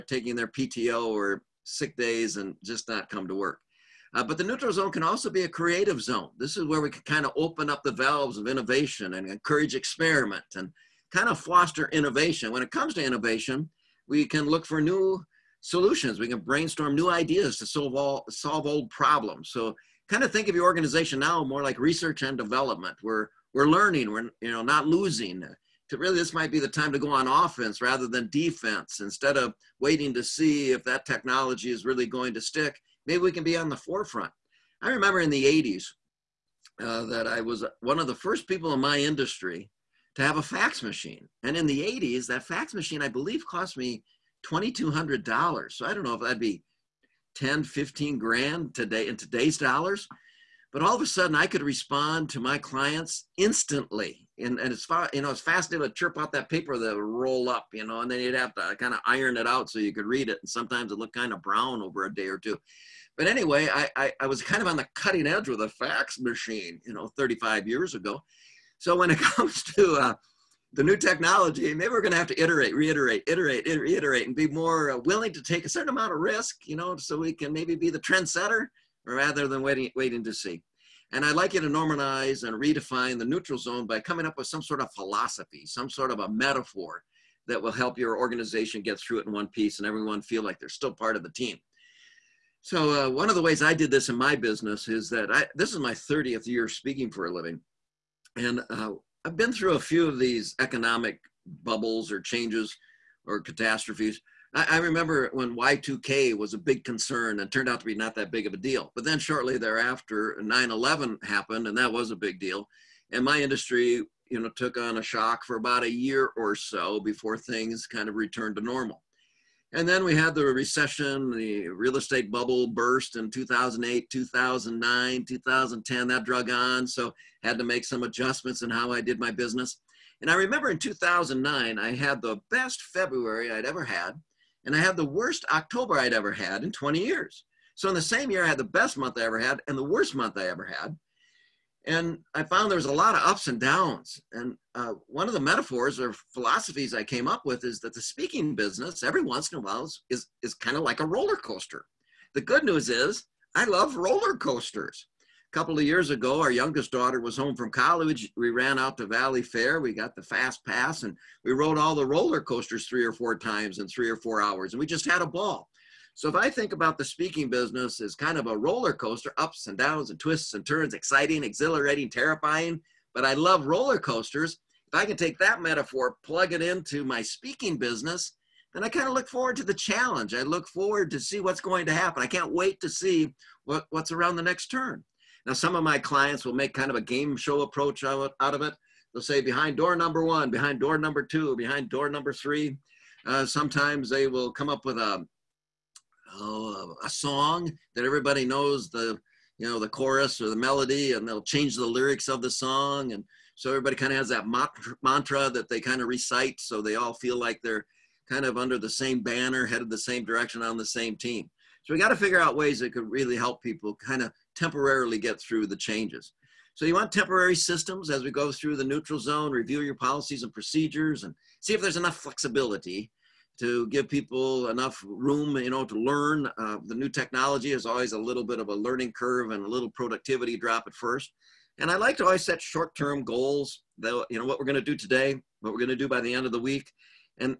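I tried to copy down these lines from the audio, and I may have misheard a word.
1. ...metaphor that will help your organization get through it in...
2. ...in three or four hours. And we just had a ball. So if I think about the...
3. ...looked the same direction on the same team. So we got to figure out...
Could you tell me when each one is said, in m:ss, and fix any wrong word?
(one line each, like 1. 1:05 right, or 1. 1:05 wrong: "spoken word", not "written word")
1. 1:26 right
2. 2:43 right
3. 3:29 wrong: "headed", not "looked".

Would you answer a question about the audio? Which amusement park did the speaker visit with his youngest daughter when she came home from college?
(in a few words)
Valleyfair.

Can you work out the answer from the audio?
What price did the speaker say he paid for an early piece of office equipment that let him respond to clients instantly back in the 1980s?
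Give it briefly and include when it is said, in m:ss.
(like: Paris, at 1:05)
$2,200, at 0:44.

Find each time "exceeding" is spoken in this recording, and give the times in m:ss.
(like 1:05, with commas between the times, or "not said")
not said.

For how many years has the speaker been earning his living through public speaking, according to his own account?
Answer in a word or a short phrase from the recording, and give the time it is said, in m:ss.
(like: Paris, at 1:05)
30, at 1:35.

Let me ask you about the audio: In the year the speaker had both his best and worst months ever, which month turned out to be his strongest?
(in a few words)
February.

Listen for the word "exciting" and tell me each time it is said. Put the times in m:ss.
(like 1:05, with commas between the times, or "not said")
2:50.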